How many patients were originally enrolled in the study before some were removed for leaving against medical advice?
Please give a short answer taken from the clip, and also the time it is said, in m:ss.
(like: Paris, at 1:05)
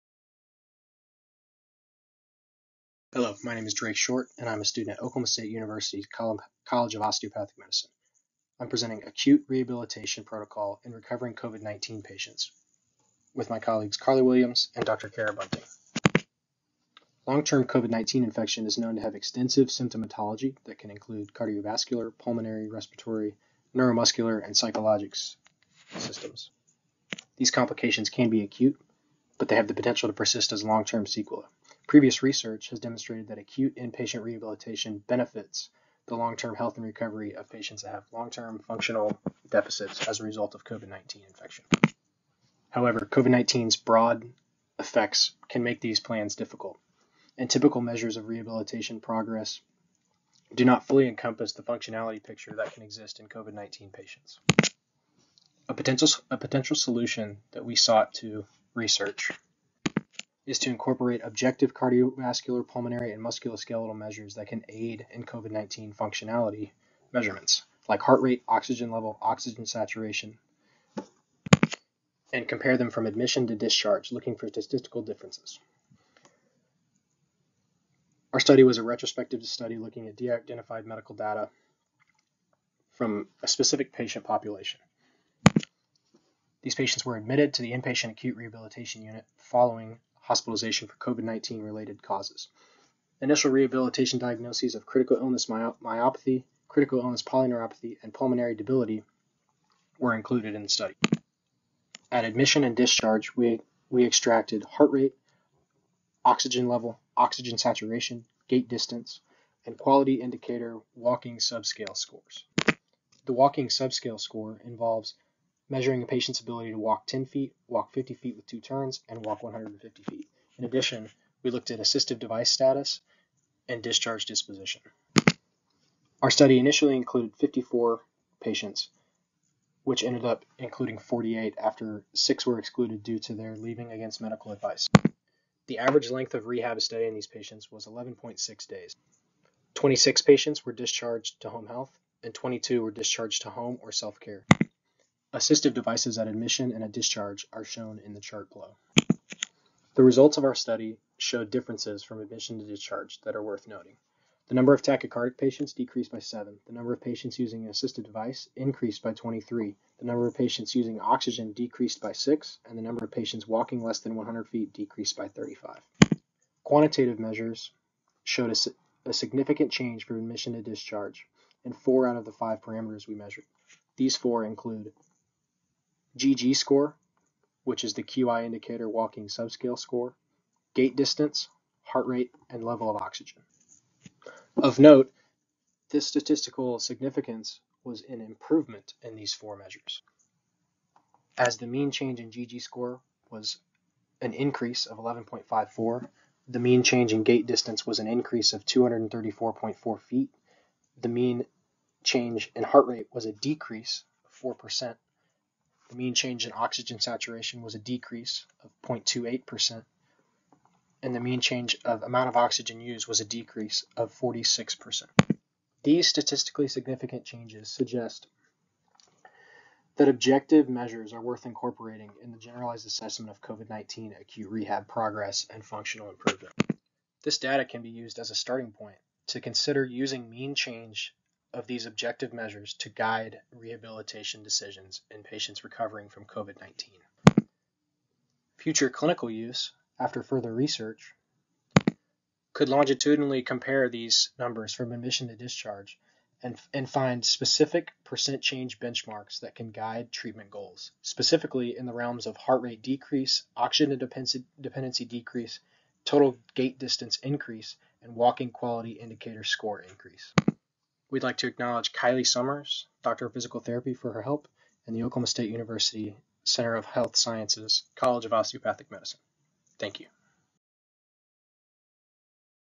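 54, at 2:07.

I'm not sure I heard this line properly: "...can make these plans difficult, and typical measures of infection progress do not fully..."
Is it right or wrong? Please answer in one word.
wrong.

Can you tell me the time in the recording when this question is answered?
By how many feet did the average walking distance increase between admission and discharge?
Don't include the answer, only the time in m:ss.
3:18.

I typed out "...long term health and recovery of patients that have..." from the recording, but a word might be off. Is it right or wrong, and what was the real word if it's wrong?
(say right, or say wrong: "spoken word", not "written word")
right.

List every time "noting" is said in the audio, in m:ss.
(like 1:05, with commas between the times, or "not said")
2:33.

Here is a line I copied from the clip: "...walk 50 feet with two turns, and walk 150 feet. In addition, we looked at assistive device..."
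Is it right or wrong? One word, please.
right.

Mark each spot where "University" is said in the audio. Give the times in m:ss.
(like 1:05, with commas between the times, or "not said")
0:05, 4:25.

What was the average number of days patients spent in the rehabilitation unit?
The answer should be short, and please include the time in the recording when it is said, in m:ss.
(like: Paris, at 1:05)
11.6 days, at 2:17.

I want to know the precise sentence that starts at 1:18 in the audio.
Our study was a retrospective study looking at de identified medical data from a specific patient population.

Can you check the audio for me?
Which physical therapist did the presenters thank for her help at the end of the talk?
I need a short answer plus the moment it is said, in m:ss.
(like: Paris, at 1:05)
Kylie Summers, at 4:21.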